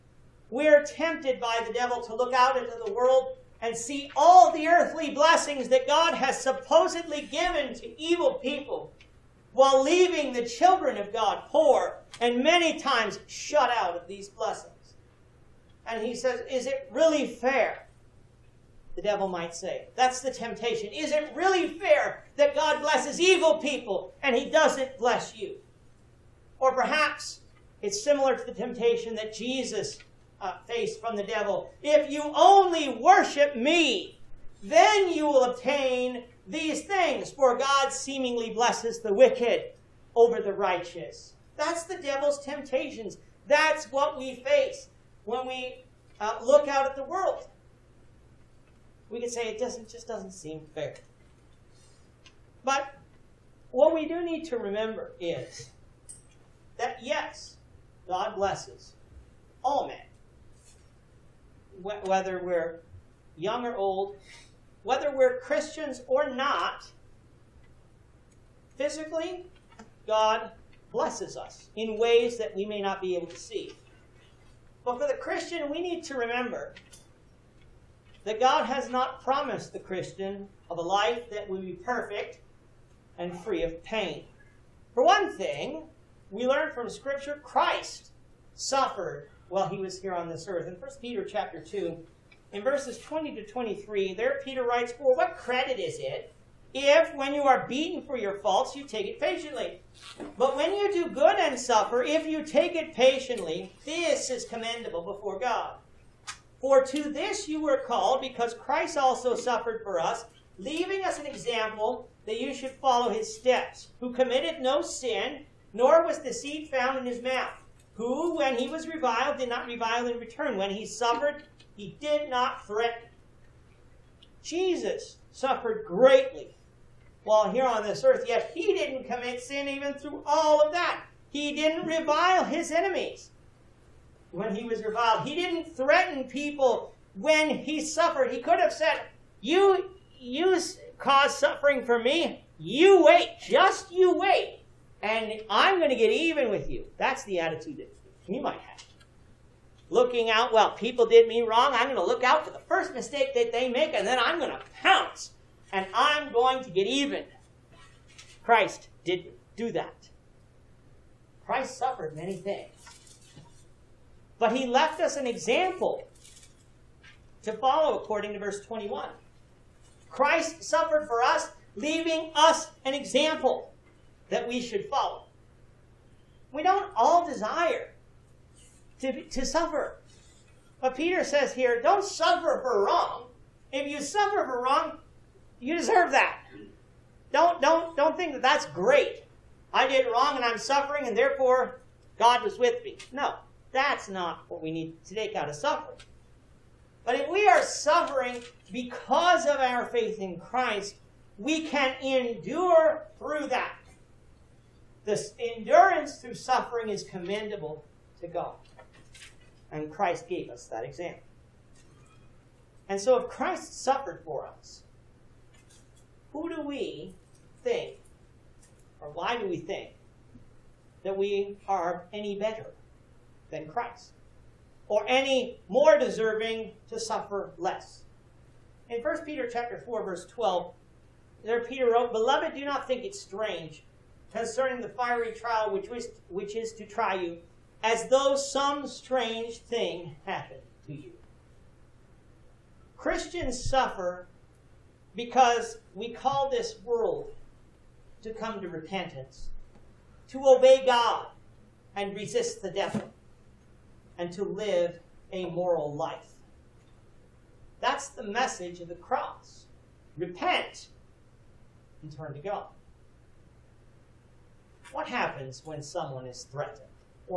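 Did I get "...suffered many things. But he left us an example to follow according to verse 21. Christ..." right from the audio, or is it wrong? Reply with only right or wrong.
right.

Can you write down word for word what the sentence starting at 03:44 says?
Or any more deserving to suffer less?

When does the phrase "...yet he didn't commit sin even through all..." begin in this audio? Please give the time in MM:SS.
02:08.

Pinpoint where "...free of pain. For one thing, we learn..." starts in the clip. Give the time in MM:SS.
01:23.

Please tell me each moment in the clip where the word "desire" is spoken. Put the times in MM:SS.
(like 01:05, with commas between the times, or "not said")
02:57.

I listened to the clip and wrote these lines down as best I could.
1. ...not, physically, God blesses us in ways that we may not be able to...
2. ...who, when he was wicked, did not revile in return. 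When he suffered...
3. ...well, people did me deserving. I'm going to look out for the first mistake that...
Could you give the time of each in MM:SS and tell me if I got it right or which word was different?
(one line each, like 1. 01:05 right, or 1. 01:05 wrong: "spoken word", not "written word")
1. 01:06 right
2. 01:57 wrong: "reviled", not "wicked"
3. 02:30 wrong: "wrong", not "deserving".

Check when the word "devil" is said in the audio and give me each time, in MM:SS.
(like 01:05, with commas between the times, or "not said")
00:01, 00:19, 00:31, 00:41, 04:12.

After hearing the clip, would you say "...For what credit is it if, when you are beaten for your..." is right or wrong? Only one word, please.
right.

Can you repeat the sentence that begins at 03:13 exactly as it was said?
No, that's not what we need to take out of suffering.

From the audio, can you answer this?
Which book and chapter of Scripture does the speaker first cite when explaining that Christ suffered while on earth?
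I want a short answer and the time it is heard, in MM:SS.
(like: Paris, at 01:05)
1 Peter 2, at 01:30.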